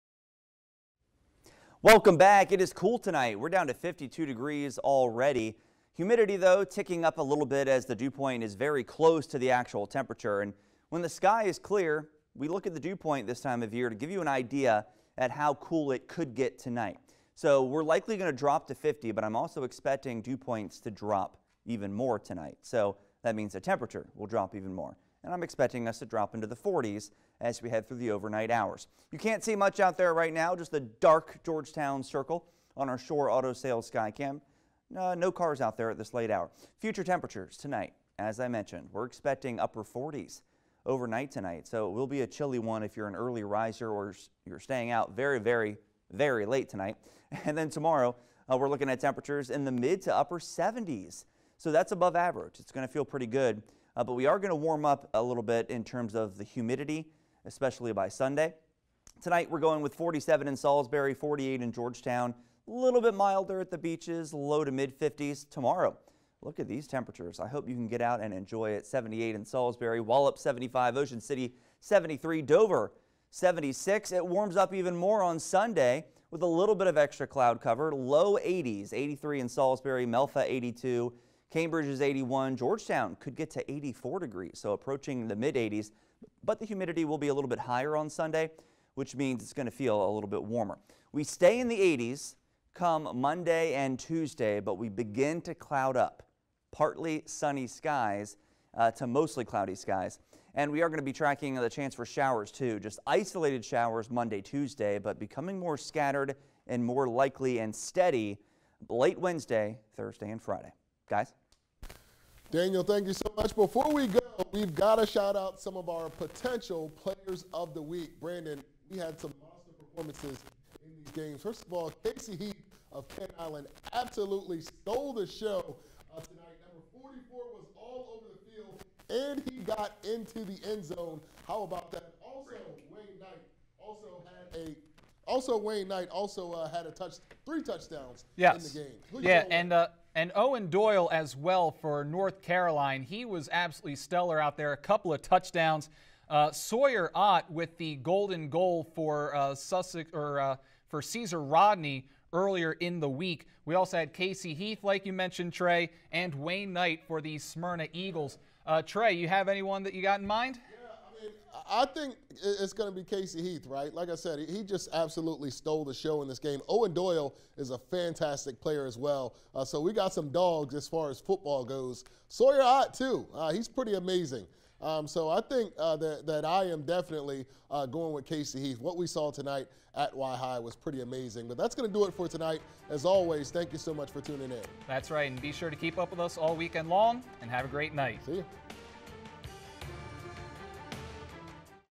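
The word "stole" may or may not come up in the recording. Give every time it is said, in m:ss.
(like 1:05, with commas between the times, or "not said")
2:04, 2:45.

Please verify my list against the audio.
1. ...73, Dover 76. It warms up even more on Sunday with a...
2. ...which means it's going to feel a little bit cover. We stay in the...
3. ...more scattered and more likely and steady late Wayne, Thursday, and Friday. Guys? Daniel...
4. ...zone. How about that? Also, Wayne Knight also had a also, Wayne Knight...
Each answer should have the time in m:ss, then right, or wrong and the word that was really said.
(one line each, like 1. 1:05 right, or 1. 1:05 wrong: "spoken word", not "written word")
1. 1:11 right
2. 1:28 wrong: "warmer", not "cover"
3. 1:45 wrong: "Wednesday", not "Wayne"
4. 2:10 right.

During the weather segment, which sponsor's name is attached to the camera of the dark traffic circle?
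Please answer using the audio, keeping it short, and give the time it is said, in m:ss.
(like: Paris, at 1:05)
Shore Auto Sales, at 0:32.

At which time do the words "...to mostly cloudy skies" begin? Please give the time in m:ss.
1:38.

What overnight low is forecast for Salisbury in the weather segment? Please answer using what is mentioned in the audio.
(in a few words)
47.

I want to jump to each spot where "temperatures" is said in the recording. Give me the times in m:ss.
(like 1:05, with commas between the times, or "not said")
0:09, 0:23, 0:37, 0:48, 1:06.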